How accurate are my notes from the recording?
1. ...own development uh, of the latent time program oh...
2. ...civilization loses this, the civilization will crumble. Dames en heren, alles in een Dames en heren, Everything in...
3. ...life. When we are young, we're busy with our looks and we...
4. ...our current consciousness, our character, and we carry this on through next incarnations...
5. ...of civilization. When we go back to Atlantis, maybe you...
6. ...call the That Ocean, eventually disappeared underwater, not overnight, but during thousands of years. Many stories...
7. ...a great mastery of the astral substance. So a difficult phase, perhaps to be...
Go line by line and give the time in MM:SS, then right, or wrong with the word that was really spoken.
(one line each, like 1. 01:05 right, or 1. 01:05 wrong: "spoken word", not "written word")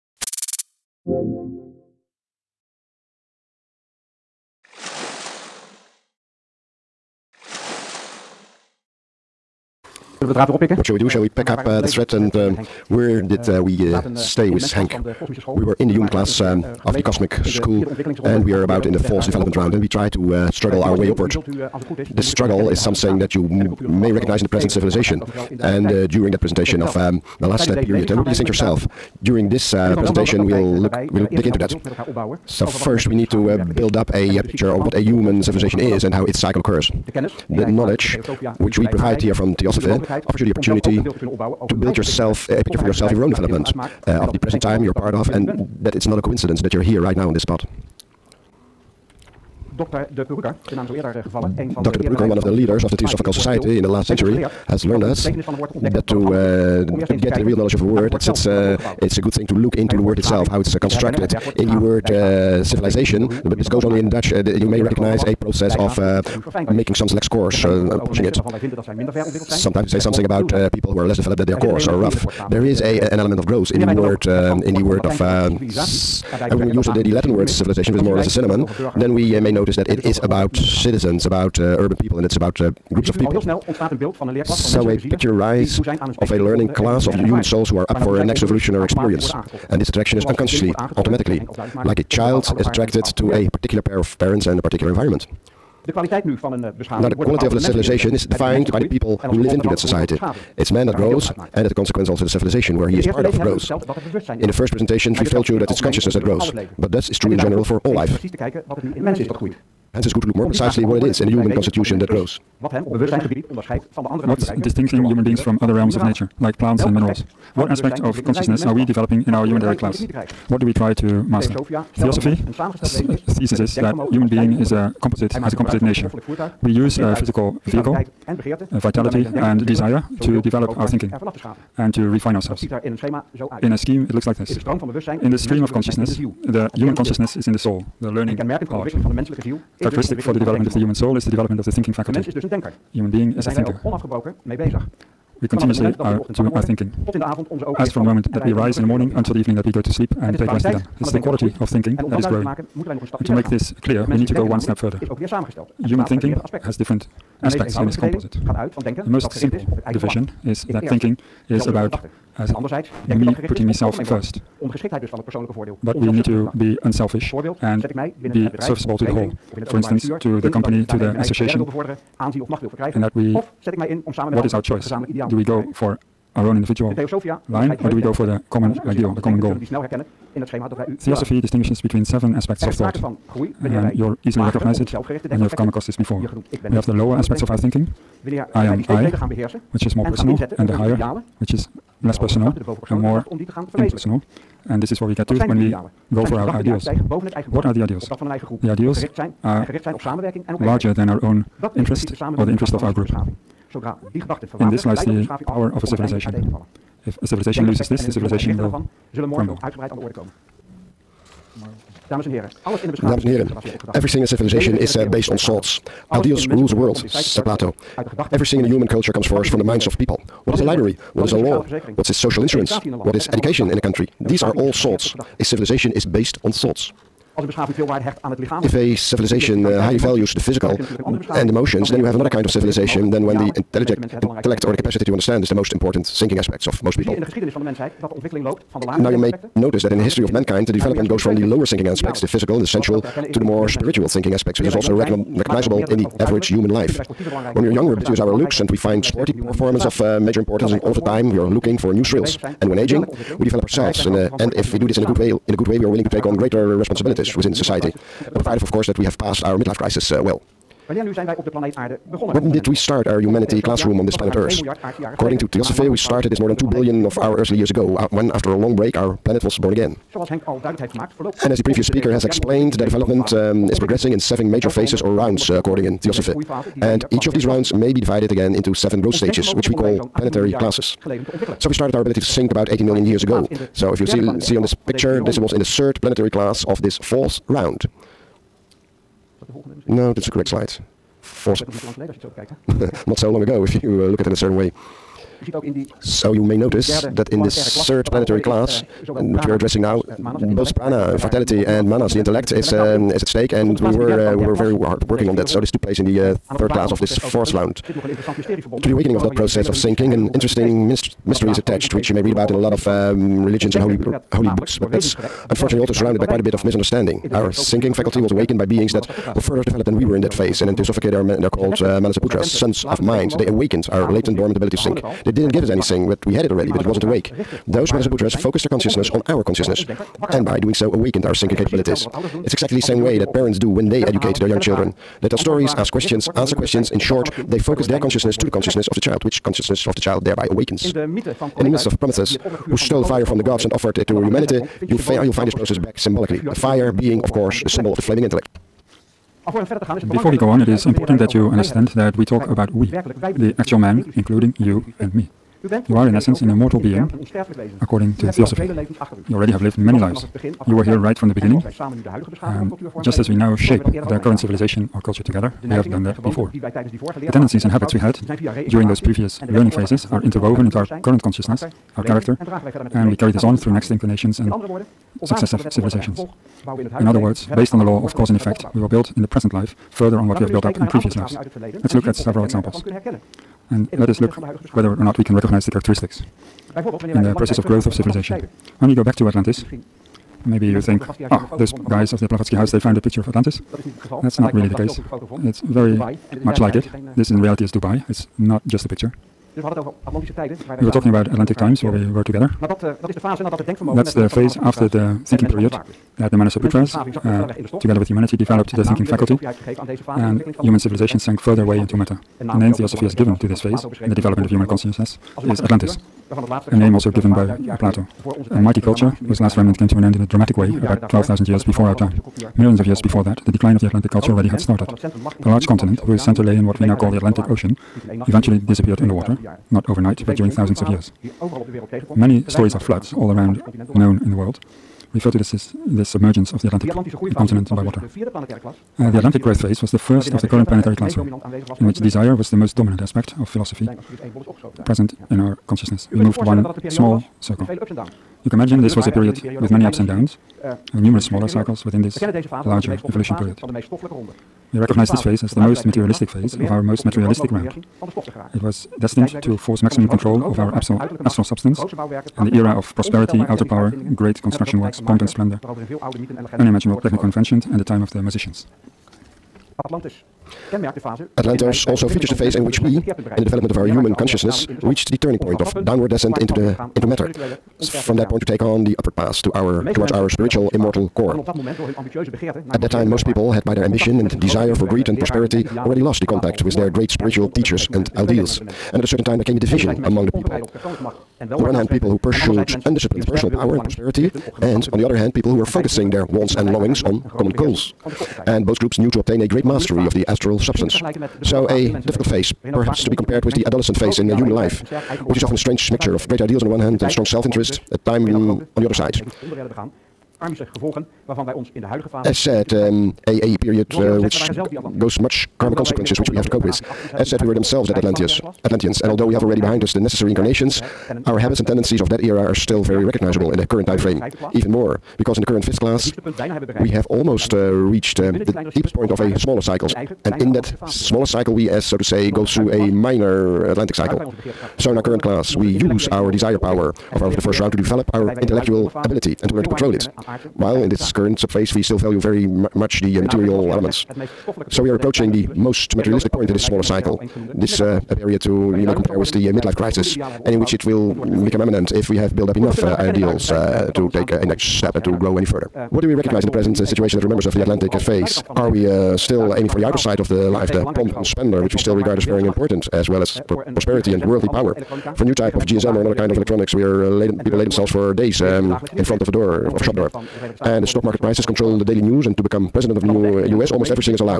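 1. 00:43 wrong: "present", not "latent"
2. 03:27 right
3. 04:06 right
4. 06:10 right
5. 06:27 right
6. 07:06 wrong: "Atlantic", not "That"
7. 08:19 right.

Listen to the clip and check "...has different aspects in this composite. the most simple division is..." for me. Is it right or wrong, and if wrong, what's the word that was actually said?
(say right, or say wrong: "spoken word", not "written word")
right.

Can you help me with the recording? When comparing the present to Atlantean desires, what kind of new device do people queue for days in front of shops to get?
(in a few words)
GSM.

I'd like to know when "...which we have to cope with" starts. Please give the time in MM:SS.
08:36.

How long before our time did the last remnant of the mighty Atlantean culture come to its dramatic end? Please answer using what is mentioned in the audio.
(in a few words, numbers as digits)
12,000 years.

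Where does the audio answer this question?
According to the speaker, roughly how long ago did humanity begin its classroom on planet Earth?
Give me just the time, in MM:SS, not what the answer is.
04:26.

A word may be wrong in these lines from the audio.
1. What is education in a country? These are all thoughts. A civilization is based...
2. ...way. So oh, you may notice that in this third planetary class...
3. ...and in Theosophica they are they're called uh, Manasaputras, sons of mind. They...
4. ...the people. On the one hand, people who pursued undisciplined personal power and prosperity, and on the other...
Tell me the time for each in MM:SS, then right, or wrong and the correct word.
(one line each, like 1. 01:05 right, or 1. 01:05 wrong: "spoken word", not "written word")
1. 03:43 right
2. 04:54 right
3. 05:20 right
4. 08:10 right.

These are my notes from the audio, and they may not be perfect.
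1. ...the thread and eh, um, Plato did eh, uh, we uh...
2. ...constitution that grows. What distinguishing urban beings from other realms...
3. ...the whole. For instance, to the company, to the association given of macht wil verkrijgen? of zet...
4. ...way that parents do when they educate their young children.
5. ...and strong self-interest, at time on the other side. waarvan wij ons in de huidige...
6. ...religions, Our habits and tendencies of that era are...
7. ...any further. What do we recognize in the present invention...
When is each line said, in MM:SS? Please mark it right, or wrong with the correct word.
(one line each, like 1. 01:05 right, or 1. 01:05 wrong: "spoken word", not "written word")
1. 00:11 wrong: "Where", not "Plato"
2. 01:51 wrong: "human", not "urban"
3. 02:49 wrong: "aanzien", not "given"
4. 05:33 right
5. 08:27 right
6. 08:40 wrong: "incarnations", not "religions"
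7. 09:15 wrong: "situation", not "invention".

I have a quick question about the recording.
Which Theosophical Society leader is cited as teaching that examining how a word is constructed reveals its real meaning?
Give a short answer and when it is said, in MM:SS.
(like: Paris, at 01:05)
Dr. De Purucker, at 00:49.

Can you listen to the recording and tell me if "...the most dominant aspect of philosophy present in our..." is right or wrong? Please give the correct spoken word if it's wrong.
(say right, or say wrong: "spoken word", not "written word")
right.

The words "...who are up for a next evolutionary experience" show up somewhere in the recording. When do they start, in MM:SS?
01:27.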